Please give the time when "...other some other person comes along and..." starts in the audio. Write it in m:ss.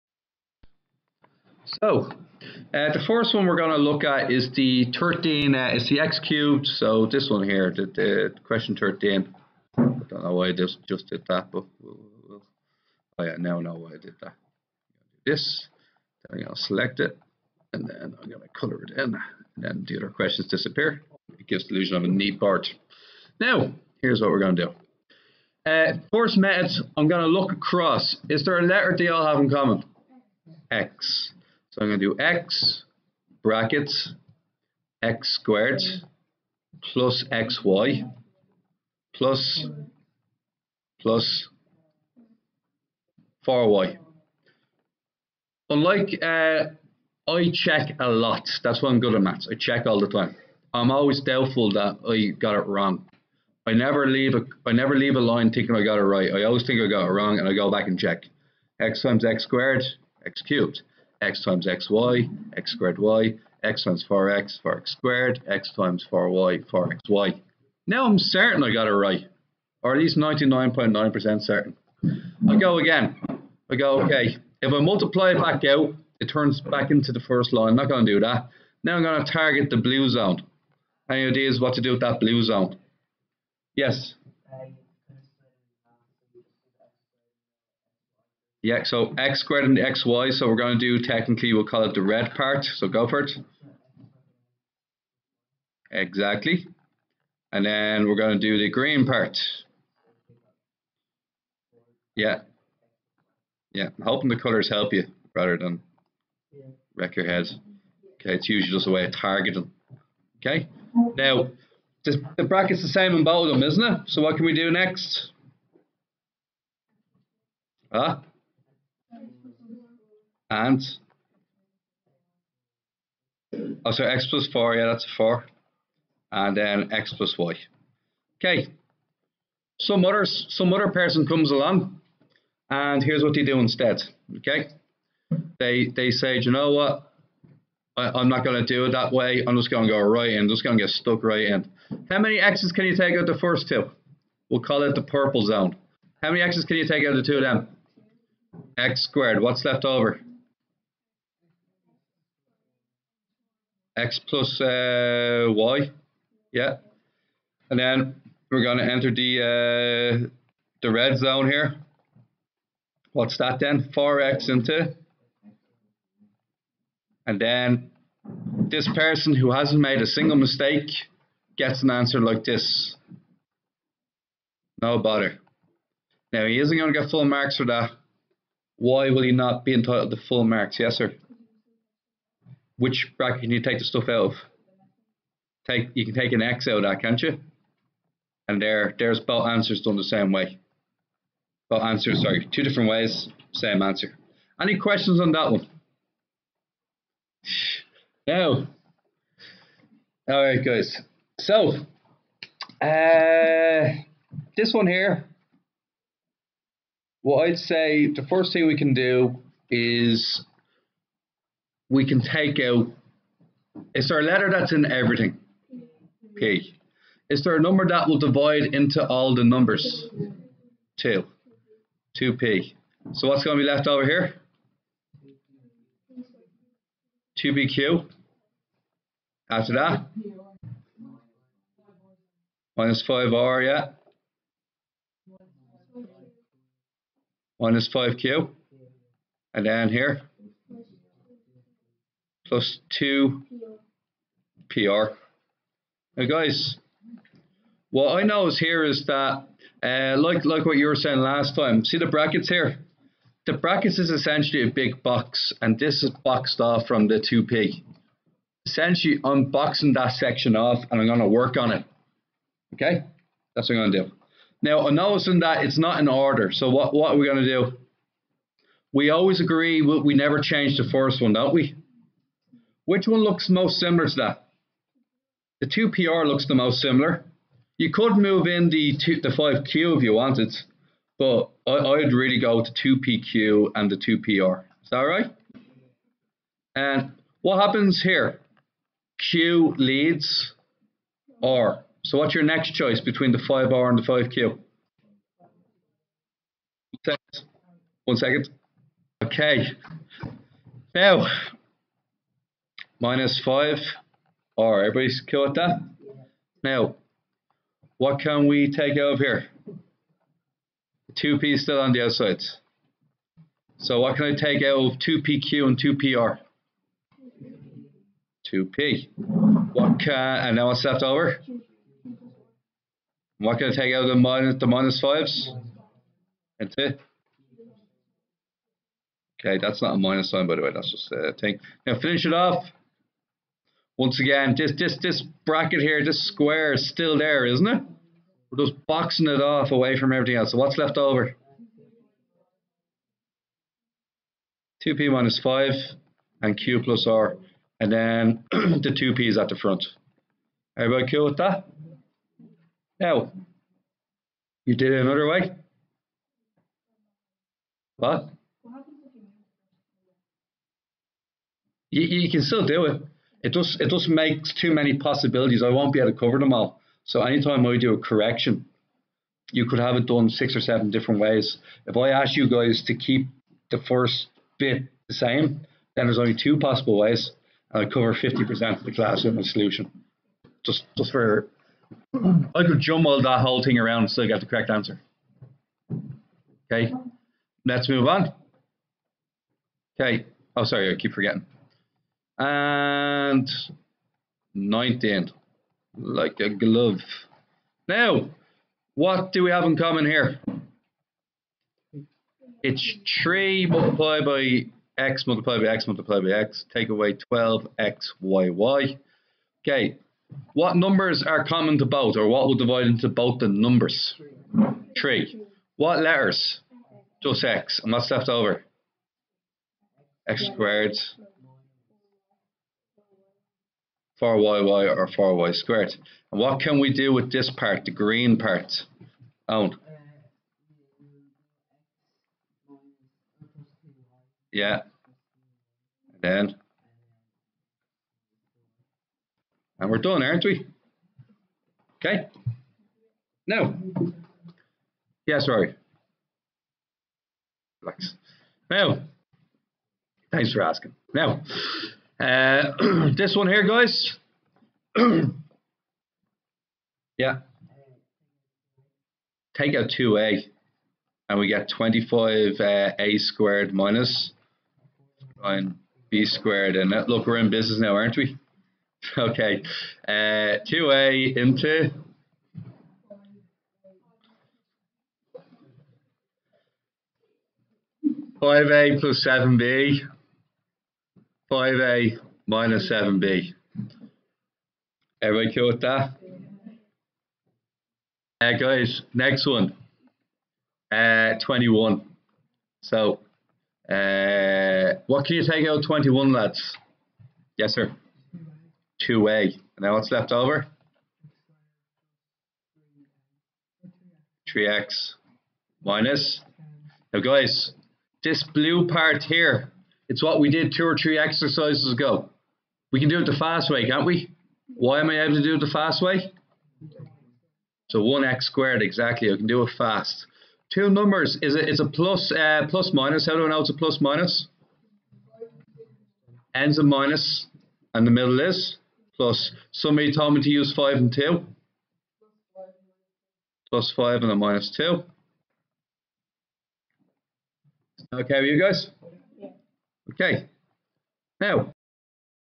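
2:10.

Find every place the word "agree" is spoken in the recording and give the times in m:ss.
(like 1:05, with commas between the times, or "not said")
4:29.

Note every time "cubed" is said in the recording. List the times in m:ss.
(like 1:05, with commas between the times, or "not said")
0:06, 1:00.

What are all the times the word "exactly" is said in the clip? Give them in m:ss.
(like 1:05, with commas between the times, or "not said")
1:35, 8:38.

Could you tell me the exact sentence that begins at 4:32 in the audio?
Which one looks most similar to that?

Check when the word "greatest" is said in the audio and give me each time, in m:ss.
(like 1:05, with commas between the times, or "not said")
not said.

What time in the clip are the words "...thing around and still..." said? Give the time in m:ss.
6:23.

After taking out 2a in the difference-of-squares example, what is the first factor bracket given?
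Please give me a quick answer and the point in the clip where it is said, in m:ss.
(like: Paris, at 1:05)
5a plus 7b, at 7:58.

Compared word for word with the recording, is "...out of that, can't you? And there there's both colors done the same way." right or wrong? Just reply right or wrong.
wrong.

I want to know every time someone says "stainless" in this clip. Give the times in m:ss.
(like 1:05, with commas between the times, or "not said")
not said.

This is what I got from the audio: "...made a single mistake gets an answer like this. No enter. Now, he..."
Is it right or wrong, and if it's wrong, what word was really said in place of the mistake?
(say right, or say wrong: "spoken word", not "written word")
wrong: "bother", not "enter".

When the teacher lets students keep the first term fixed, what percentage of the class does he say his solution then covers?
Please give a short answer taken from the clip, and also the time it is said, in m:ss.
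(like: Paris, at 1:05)
50%, at 6:18.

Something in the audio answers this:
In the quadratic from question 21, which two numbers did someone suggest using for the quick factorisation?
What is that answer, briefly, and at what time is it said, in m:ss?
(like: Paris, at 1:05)
5 and 2, at 8:50.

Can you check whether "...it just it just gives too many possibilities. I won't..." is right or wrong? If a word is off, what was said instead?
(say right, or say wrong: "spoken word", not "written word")
wrong: "makes", not "gives".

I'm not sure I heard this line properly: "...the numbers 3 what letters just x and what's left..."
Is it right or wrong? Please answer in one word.
right.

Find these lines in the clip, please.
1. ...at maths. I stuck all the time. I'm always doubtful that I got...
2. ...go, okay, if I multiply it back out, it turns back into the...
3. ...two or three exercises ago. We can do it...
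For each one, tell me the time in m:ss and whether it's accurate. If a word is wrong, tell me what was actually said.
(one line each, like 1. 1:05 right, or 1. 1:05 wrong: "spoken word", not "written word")
1. 0:49 wrong: "check", not "stuck"
2. 1:13 right
3. 8:30 right.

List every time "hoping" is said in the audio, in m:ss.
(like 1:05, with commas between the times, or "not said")
1:44.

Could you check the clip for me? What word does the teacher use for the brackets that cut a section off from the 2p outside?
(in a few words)
box.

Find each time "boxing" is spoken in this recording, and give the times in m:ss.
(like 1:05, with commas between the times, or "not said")
4:19, 5:38.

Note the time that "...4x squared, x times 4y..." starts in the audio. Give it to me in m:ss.
1:04.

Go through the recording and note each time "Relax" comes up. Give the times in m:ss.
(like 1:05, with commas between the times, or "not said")
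7:27.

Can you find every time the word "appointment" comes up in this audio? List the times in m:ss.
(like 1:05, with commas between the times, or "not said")
not said.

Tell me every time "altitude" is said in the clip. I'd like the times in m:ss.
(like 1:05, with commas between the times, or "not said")
not said.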